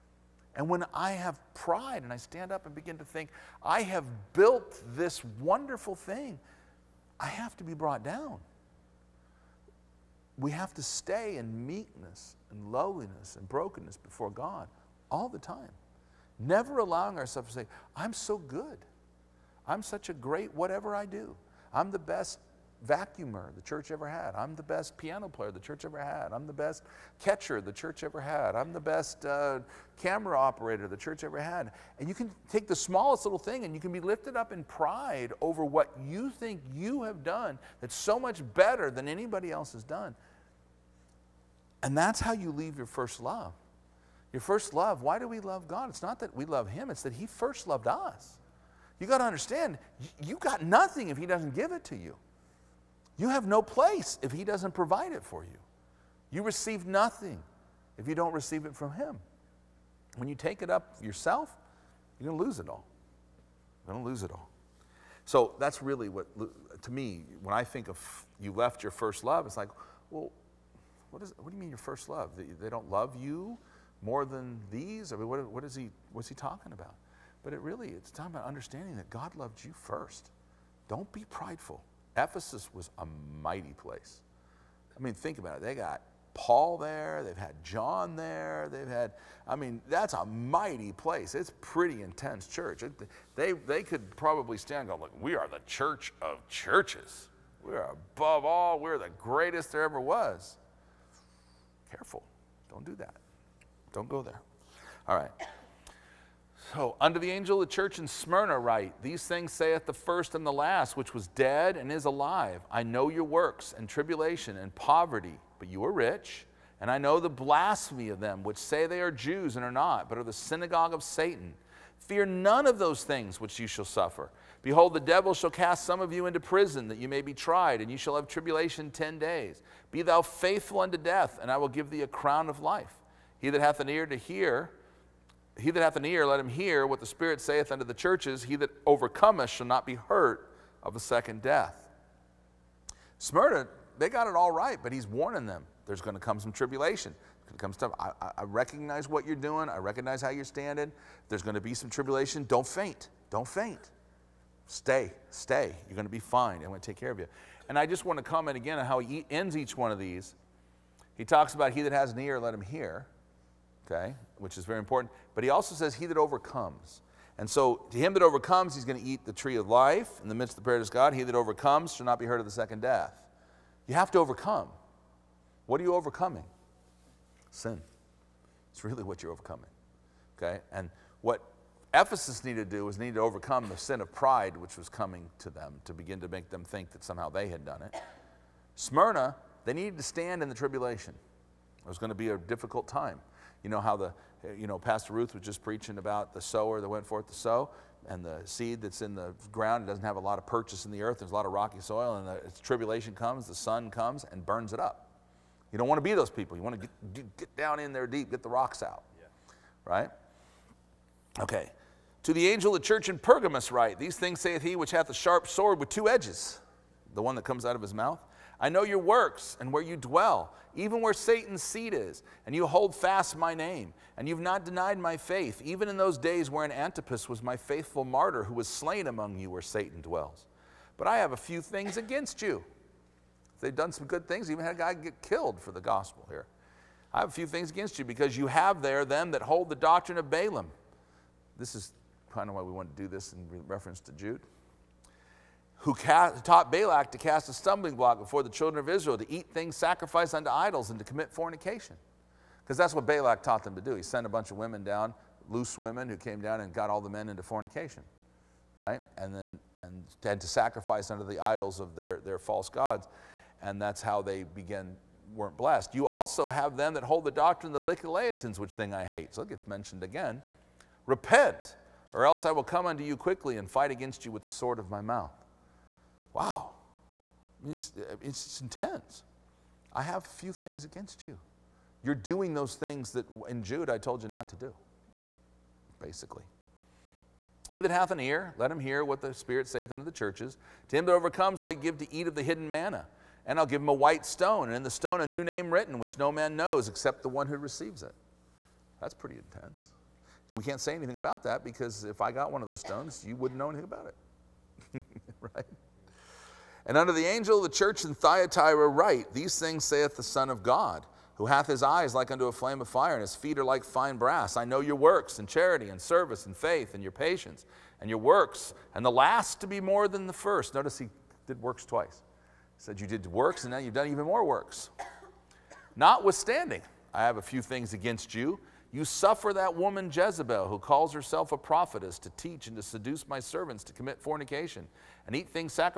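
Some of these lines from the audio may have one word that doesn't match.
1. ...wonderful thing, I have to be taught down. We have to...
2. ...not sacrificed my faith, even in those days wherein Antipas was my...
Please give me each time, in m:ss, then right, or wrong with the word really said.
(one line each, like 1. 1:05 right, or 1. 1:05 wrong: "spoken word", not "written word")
1. 0:05 wrong: "brought", not "taught"
2. 3:44 wrong: "denied", not "sacrificed".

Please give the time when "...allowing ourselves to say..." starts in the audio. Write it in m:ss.
0:16.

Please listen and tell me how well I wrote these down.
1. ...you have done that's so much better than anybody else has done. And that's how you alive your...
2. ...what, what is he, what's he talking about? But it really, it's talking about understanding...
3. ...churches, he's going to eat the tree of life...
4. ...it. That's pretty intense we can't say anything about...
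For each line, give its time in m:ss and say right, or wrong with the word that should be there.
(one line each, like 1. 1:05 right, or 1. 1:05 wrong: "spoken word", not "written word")
1. 0:36 wrong: "leave", not "alive"
2. 1:15 right
3. 2:48 wrong: "overcomes", not "churches"
4. 4:58 right.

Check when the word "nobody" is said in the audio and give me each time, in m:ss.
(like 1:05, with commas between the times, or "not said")
not said.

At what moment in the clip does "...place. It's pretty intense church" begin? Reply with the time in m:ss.
1:30.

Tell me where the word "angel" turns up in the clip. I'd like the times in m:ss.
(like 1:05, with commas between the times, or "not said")
1:47, 3:32, 5:07.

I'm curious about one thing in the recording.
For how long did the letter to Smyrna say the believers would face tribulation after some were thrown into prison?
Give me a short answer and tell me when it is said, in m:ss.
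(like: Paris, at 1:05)
10 days, at 2:08.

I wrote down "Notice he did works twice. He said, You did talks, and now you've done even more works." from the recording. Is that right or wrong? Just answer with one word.
wrong.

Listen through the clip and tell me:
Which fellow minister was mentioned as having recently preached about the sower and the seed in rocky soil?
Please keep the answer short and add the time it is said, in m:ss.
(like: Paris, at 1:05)
Pastor Ruth, at 3:14.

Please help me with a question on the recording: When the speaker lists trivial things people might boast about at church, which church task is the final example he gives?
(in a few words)
Camera operator.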